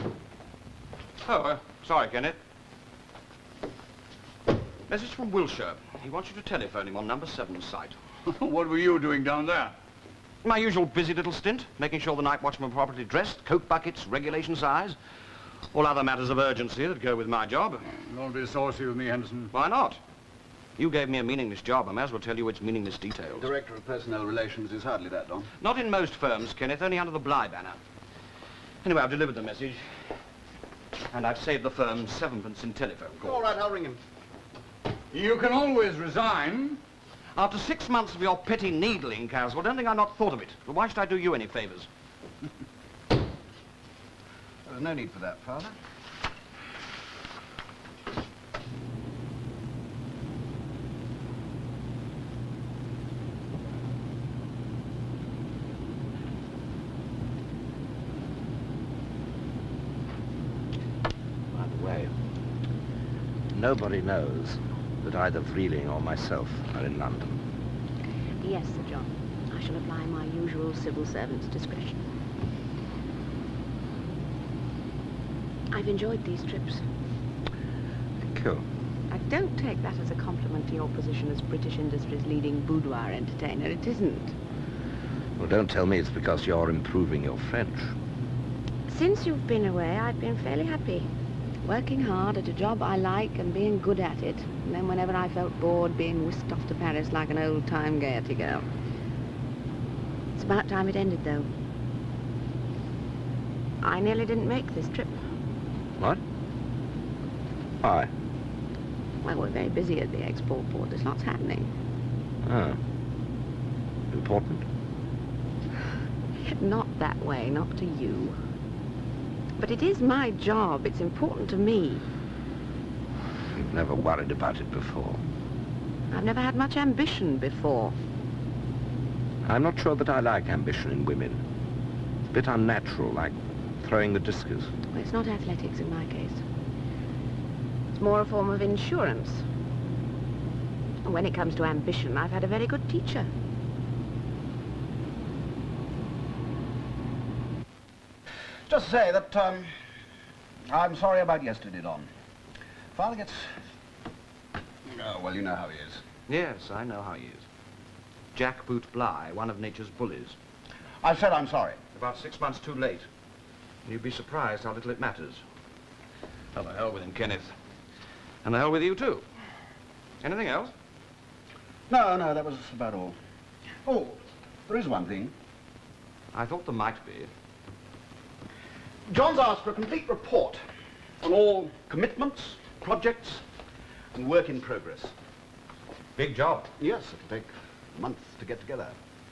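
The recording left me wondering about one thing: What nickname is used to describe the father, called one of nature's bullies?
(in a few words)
Jack Boot Bligh.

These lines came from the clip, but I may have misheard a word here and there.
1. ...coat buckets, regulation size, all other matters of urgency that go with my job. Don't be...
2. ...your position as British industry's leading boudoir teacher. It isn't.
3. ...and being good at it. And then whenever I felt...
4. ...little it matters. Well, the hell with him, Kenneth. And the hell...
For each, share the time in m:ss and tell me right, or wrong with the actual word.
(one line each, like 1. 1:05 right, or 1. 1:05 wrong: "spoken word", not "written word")
1. 0:13 right
2. 1:20 wrong: "entertainer", not "teacher"
3. 1:33 right
4. 2:44 right.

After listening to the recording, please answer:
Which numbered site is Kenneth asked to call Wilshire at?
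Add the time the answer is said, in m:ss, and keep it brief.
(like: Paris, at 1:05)
7, at 0:07.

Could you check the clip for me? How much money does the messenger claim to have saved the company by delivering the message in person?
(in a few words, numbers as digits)
7 pence.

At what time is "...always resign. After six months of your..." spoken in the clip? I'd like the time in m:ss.
0:35.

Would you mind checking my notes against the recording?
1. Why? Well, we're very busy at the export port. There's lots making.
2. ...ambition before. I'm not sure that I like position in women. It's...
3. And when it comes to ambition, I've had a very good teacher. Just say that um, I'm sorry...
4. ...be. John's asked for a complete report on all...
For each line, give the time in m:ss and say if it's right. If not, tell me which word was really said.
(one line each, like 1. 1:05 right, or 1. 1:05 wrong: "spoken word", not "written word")
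1. 1:47 wrong: "happening", not "making"
2. 2:06 wrong: "ambition", not "position"
3. 2:21 right
4. 2:57 right.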